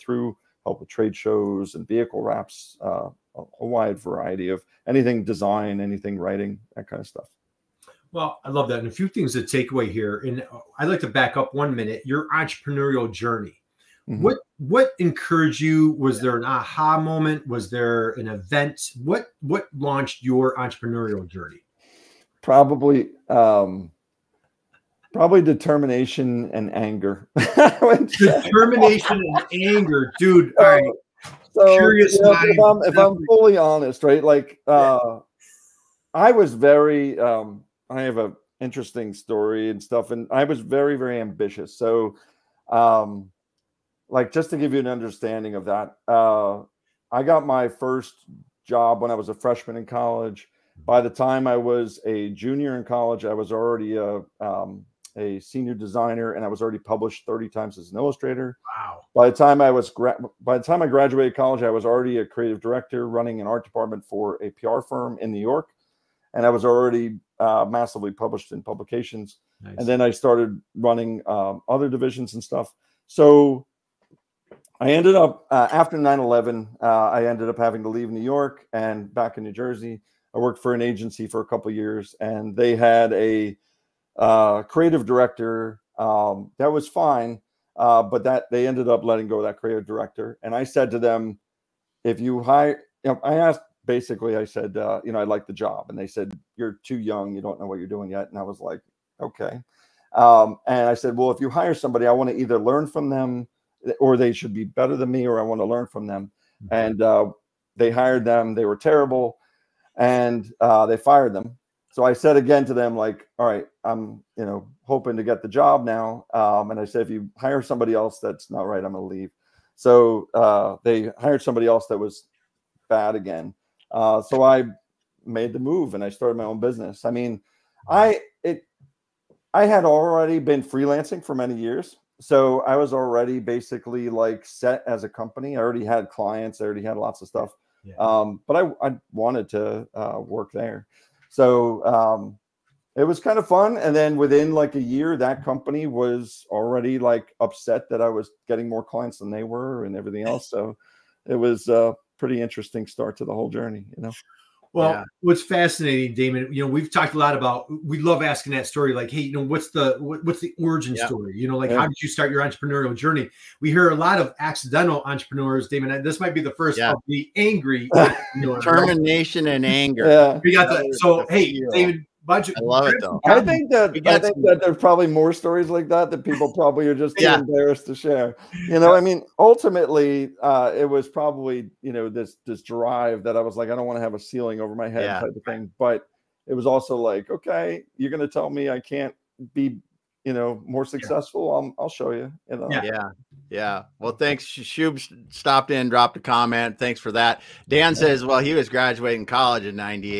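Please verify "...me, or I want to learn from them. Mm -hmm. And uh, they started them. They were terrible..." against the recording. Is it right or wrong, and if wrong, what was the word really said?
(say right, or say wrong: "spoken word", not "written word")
wrong: "hired", not "started".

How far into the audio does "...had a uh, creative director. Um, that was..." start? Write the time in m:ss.
1:22.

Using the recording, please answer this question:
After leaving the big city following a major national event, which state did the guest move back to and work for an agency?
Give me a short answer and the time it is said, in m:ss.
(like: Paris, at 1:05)
New Jersey, at 1:19.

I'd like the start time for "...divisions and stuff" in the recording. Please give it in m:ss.
1:11.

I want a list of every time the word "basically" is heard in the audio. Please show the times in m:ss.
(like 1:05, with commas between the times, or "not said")
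1:33, 2:13.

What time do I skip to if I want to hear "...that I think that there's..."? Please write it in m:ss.
2:53.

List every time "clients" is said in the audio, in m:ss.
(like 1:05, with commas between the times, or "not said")
2:16, 2:28.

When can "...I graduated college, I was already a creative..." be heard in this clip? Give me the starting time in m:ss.
1:00.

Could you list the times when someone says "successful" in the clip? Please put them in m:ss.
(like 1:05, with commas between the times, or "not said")
3:10.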